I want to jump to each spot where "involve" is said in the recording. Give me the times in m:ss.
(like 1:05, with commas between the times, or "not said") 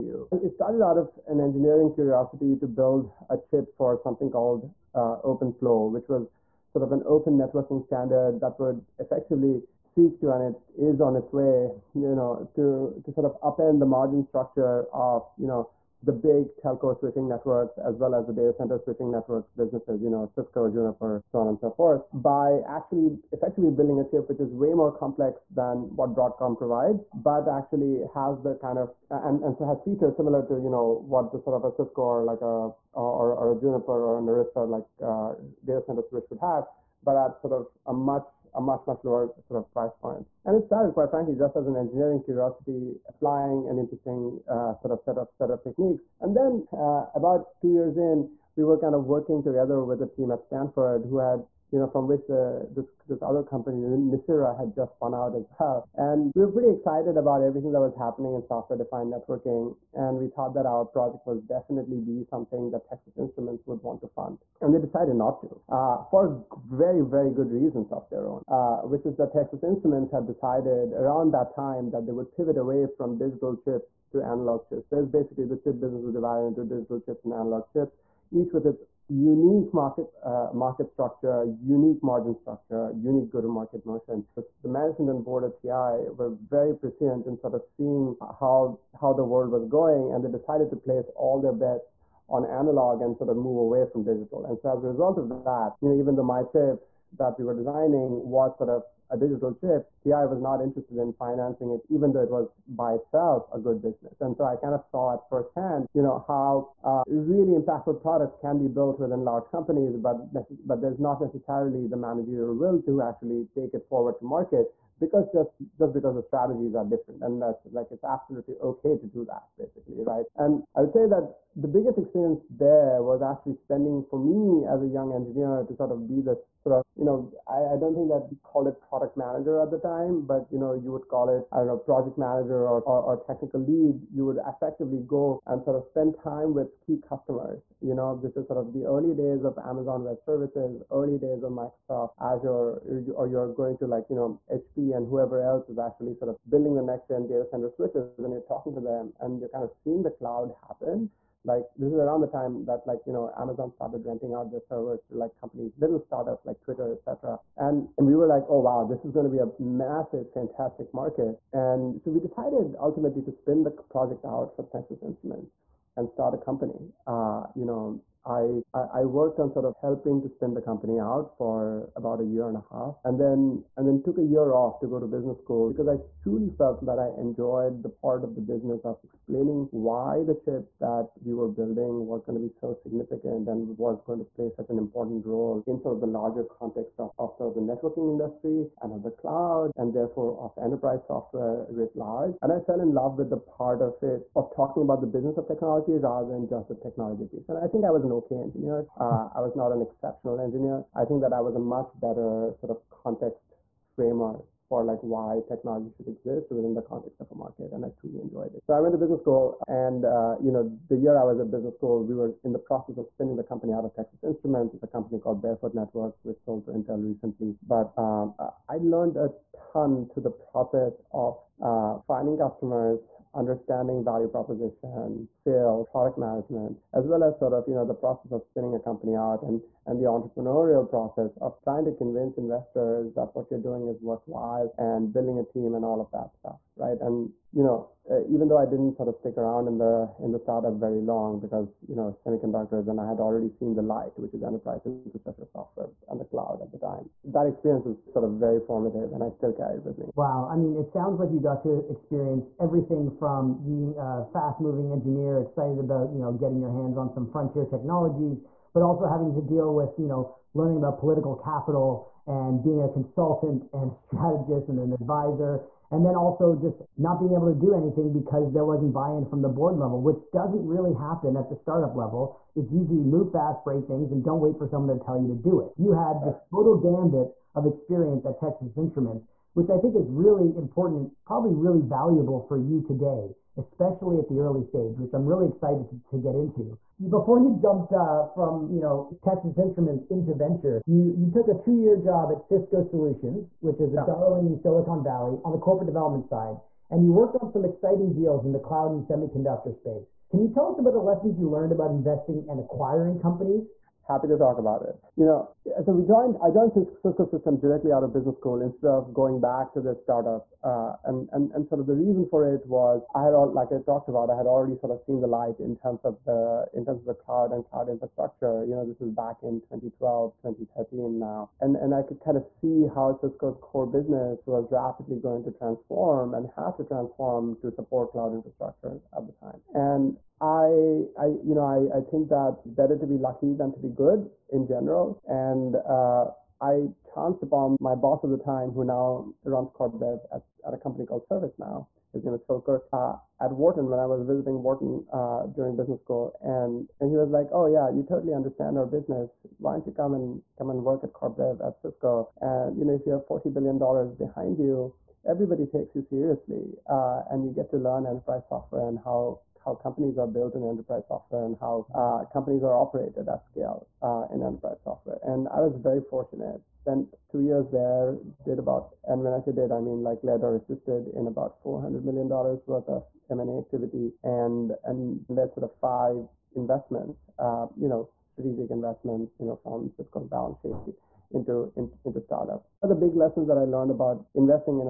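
not said.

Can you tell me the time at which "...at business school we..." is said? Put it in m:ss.
3:31.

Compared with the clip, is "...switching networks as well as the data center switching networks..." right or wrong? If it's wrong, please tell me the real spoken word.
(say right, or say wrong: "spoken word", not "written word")
right.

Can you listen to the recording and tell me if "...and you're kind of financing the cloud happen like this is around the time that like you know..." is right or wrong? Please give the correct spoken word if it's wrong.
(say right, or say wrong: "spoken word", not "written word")
wrong: "seeing", not "financing".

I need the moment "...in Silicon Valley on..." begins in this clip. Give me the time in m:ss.
4:54.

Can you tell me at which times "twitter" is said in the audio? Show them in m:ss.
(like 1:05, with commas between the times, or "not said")
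2:36.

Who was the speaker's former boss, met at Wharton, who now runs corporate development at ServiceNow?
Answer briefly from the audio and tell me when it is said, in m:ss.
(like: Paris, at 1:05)
Phil Kirk, at 5:42.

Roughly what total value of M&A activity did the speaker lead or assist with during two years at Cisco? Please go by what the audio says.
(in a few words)
$400 million.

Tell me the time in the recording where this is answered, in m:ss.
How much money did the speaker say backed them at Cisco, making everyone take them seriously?
5:53.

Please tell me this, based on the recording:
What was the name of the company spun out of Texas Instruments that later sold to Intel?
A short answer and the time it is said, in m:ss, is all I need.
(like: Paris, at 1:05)
Barefoot Networks, at 3:35.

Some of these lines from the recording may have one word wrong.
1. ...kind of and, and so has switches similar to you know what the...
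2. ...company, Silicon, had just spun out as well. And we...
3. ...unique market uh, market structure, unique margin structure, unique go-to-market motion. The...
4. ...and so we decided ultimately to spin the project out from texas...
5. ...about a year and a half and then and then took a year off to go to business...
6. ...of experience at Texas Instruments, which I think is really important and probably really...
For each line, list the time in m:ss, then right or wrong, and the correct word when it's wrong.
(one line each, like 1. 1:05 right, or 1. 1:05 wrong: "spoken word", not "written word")
1. 0:28 wrong: "features", not "switches"
2. 0:53 wrong: "Nicira", not "Silicon"
3. 1:19 right
4. 2:41 right
5. 2:51 right
6. 4:37 right.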